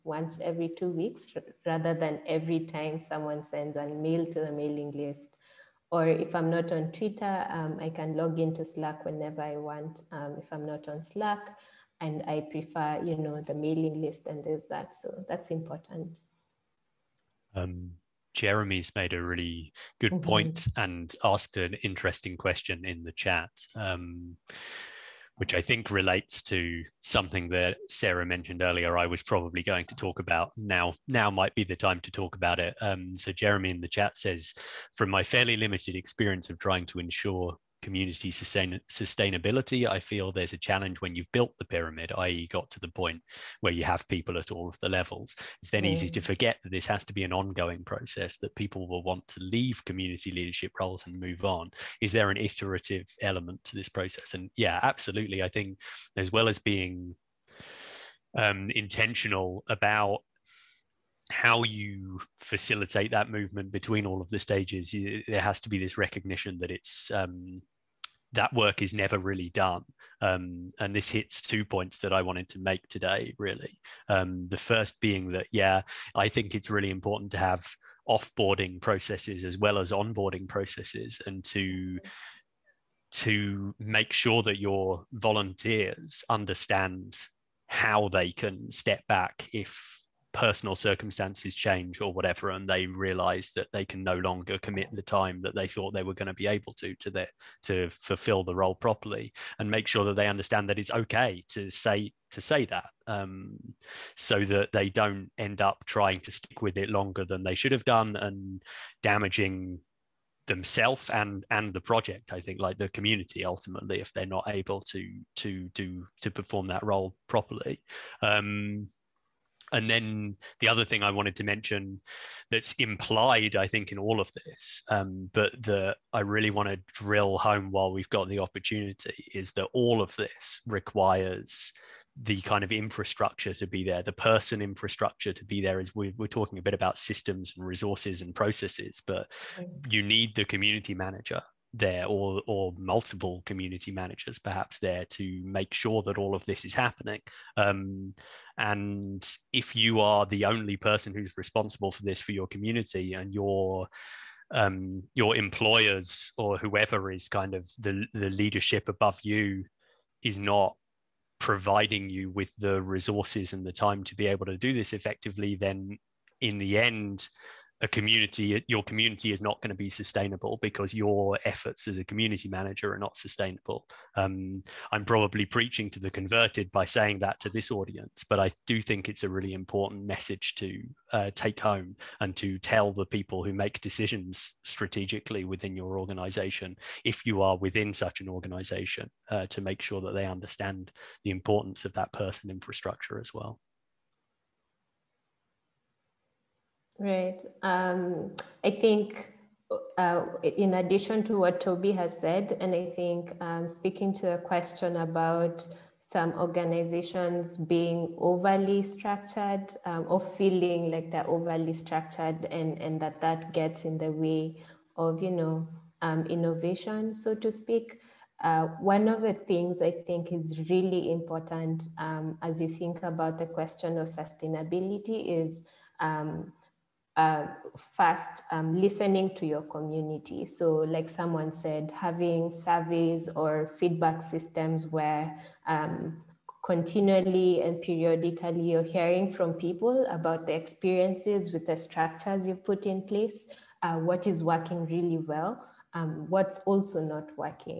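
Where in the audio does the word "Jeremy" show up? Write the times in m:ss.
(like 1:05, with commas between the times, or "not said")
0:18, 0:33.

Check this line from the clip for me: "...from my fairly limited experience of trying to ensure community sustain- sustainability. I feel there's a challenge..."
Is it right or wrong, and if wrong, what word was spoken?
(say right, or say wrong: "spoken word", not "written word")
right.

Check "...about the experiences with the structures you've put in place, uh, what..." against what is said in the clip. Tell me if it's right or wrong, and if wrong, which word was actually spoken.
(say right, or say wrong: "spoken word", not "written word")
right.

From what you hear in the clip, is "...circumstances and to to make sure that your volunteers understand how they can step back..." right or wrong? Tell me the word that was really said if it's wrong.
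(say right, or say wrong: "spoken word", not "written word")
wrong: "processes", not "circumstances".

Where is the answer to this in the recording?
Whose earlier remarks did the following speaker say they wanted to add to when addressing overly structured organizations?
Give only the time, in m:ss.
3:21.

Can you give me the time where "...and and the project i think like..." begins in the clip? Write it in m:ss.
1:51.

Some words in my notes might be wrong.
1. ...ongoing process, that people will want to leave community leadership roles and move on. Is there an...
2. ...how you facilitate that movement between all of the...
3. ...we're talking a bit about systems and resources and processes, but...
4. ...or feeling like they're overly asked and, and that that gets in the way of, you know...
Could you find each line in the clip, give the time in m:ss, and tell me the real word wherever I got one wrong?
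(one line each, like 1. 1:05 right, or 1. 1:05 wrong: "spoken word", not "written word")
1. 0:47 right
2. 1:01 right
3. 2:16 right
4. 3:30 wrong: "structured", not "asked".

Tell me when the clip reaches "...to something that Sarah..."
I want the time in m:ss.
0:26.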